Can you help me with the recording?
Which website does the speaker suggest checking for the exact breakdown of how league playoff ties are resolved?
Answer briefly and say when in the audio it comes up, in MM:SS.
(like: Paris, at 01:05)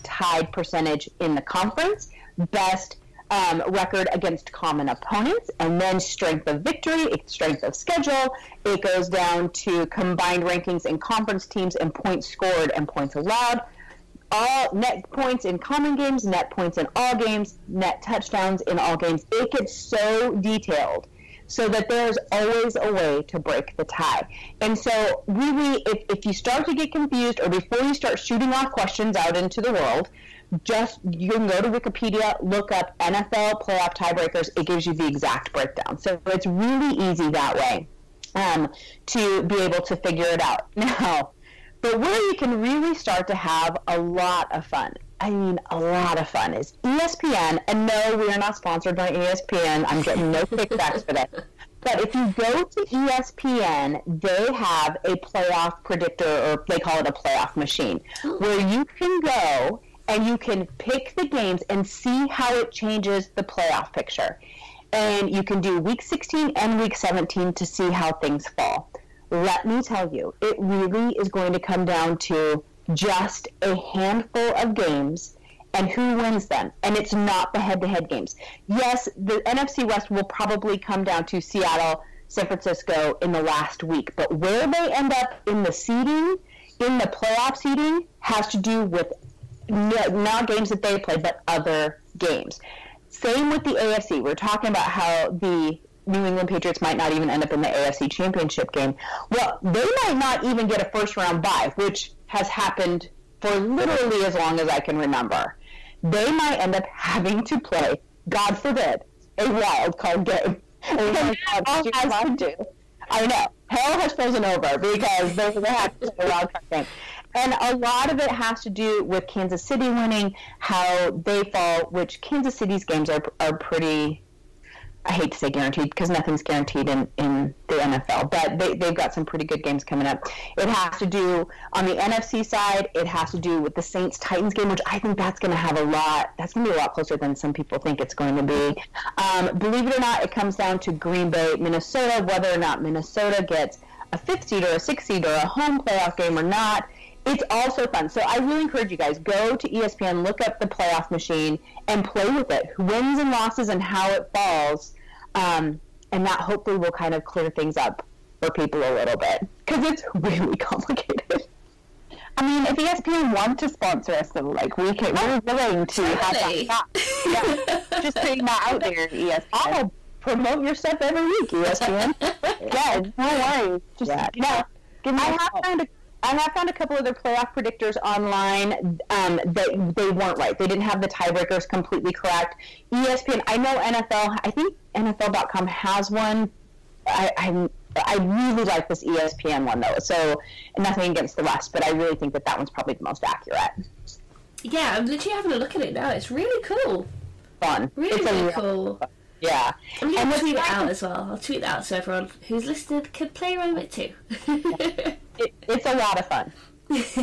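Wikipedia, at 00:31.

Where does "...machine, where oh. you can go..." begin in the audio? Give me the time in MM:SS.
00:57.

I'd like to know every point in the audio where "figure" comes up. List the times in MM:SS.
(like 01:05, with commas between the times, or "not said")
00:39.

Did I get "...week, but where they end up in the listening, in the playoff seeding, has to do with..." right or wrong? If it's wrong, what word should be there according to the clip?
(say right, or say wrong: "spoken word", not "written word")
wrong: "seeding", not "listening".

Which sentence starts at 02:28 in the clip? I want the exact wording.
So I really encourage you guys go to ESPN, look up the playoff machine, and play with it.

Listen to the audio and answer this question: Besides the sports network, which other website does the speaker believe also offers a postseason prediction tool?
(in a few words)
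NFL.com.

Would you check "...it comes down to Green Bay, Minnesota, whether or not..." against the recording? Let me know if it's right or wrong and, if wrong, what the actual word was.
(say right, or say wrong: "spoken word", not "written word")
right.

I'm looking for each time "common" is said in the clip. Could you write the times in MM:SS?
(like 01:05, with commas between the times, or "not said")
00:04, 00:15.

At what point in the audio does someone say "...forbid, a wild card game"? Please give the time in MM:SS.
01:48.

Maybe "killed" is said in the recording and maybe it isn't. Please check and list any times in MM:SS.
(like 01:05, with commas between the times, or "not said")
not said.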